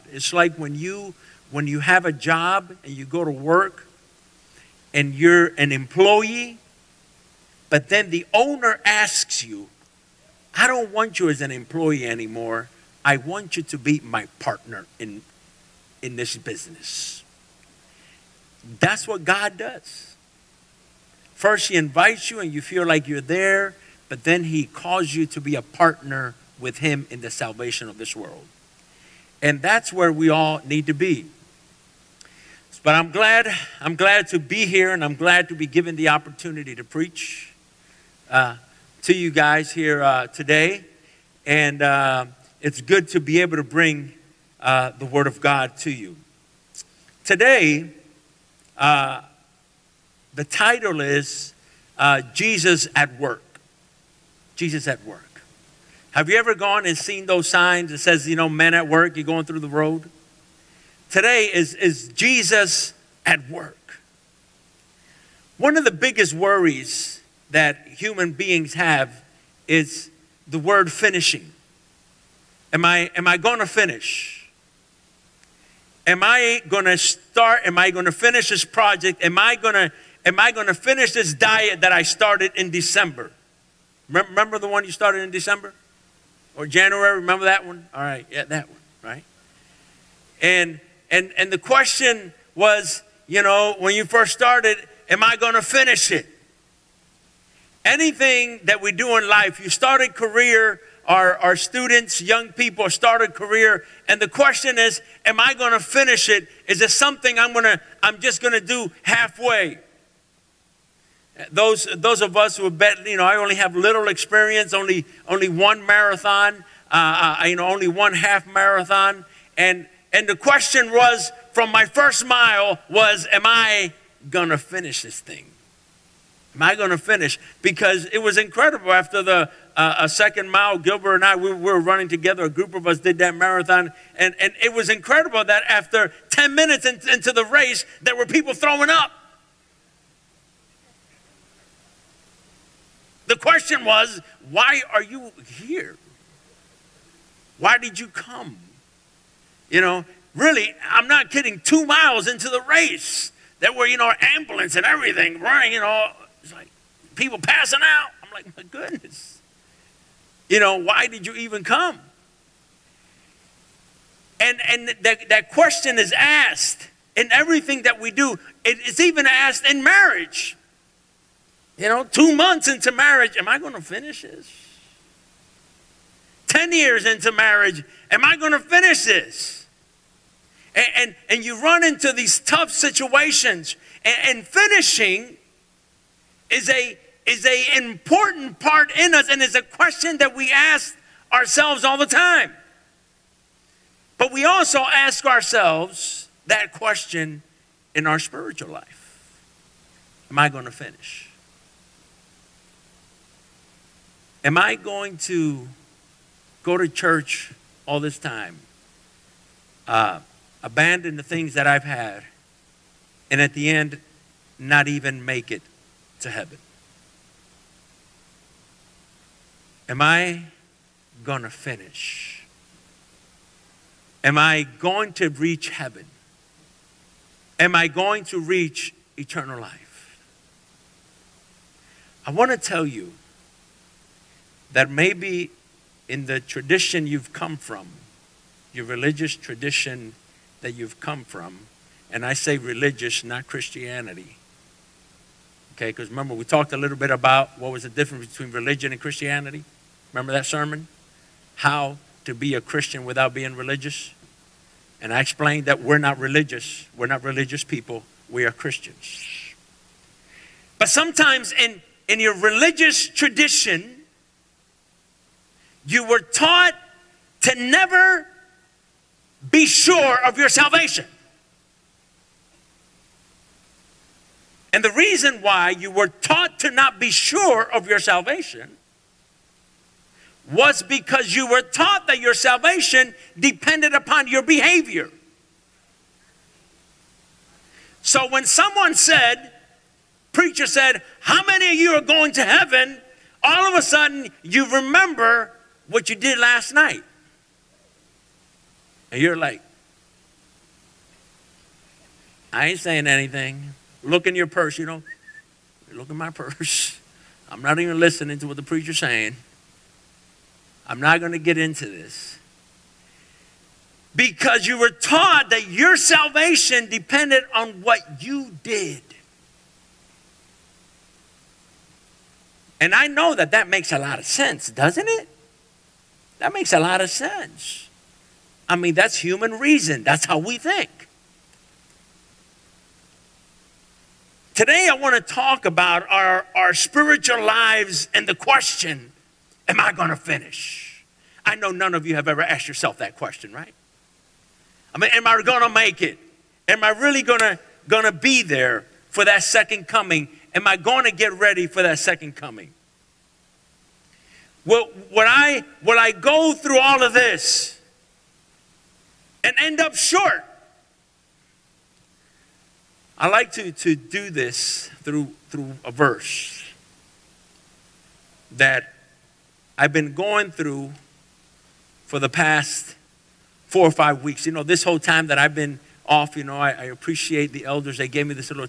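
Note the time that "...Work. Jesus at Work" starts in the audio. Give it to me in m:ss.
0:53.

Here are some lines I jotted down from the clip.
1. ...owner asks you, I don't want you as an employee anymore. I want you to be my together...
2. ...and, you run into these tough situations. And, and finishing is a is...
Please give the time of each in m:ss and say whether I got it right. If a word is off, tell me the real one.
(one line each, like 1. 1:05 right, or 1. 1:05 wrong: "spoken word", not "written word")
1. 0:08 wrong: "partner", not "together"
2. 3:01 right.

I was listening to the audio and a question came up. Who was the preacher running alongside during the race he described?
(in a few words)
Gilbert.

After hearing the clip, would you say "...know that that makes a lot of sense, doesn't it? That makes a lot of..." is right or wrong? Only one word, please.
right.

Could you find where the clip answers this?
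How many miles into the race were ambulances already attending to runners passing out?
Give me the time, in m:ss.
2:31.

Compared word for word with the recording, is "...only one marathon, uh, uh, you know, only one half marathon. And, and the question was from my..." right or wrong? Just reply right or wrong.
right.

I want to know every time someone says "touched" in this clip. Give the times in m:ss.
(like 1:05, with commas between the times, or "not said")
not said.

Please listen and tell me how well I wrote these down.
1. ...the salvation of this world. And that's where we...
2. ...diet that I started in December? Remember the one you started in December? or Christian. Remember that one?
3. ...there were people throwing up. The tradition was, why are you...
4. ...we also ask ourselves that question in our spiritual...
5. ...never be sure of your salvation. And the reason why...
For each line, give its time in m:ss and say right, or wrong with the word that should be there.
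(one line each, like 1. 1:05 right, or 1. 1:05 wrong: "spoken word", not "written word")
1. 0:27 right
2. 1:21 wrong: "January", not "Christian"
3. 2:18 wrong: "question", not "tradition"
4. 3:14 right
5. 4:27 right.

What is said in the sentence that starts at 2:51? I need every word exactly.
You know, two months into marriage, am I going to finish this?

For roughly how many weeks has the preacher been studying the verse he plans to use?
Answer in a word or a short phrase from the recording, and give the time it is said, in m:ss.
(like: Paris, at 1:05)
4 or 5, at 6:13.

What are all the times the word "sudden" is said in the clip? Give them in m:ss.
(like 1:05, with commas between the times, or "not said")
4:53.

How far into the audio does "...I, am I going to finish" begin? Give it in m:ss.
1:12.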